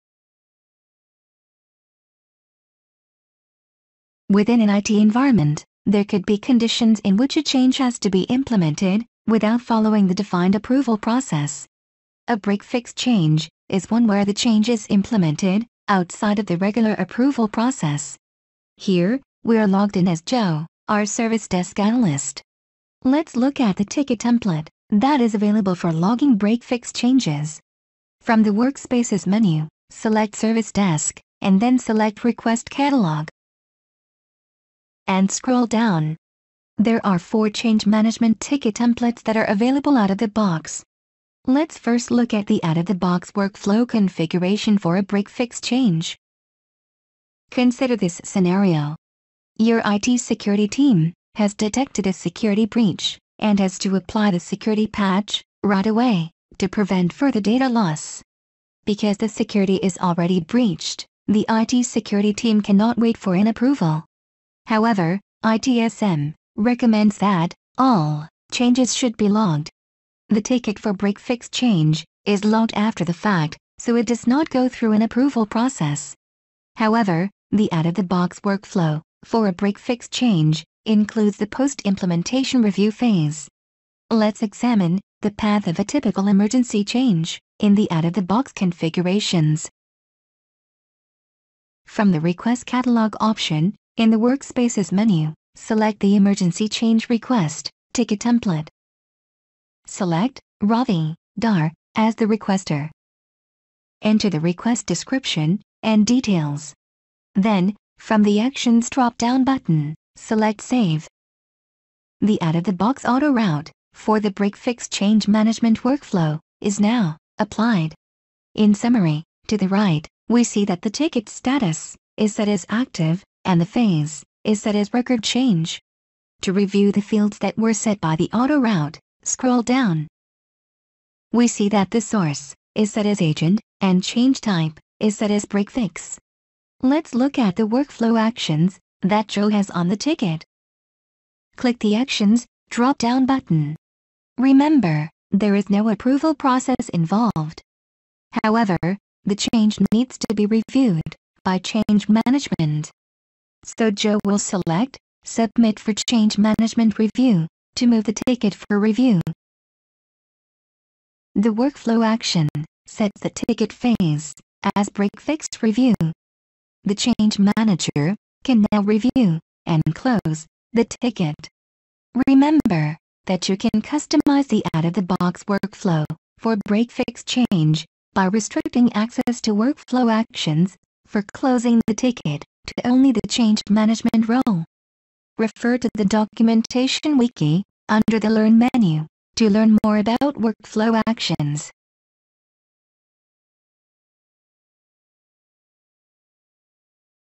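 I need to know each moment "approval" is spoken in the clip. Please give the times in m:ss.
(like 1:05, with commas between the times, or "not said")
0:10, 0:16, 1:03, 1:15, 2:25.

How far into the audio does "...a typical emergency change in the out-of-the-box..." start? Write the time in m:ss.
1:25.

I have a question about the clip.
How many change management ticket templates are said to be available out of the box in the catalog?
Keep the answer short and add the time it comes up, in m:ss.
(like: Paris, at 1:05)
4, at 0:37.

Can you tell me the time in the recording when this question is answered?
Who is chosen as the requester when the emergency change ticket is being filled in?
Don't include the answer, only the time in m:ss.
1:40.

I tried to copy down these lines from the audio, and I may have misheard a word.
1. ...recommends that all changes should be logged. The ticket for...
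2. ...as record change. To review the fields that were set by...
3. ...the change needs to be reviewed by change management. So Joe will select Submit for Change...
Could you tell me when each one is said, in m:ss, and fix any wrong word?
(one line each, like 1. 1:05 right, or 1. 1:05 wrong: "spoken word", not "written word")
1. 1:06 right
2. 2:04 right
3. 2:29 right.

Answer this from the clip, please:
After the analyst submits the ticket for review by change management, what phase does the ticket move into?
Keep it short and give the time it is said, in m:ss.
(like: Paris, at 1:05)
break-fix review, at 2:44.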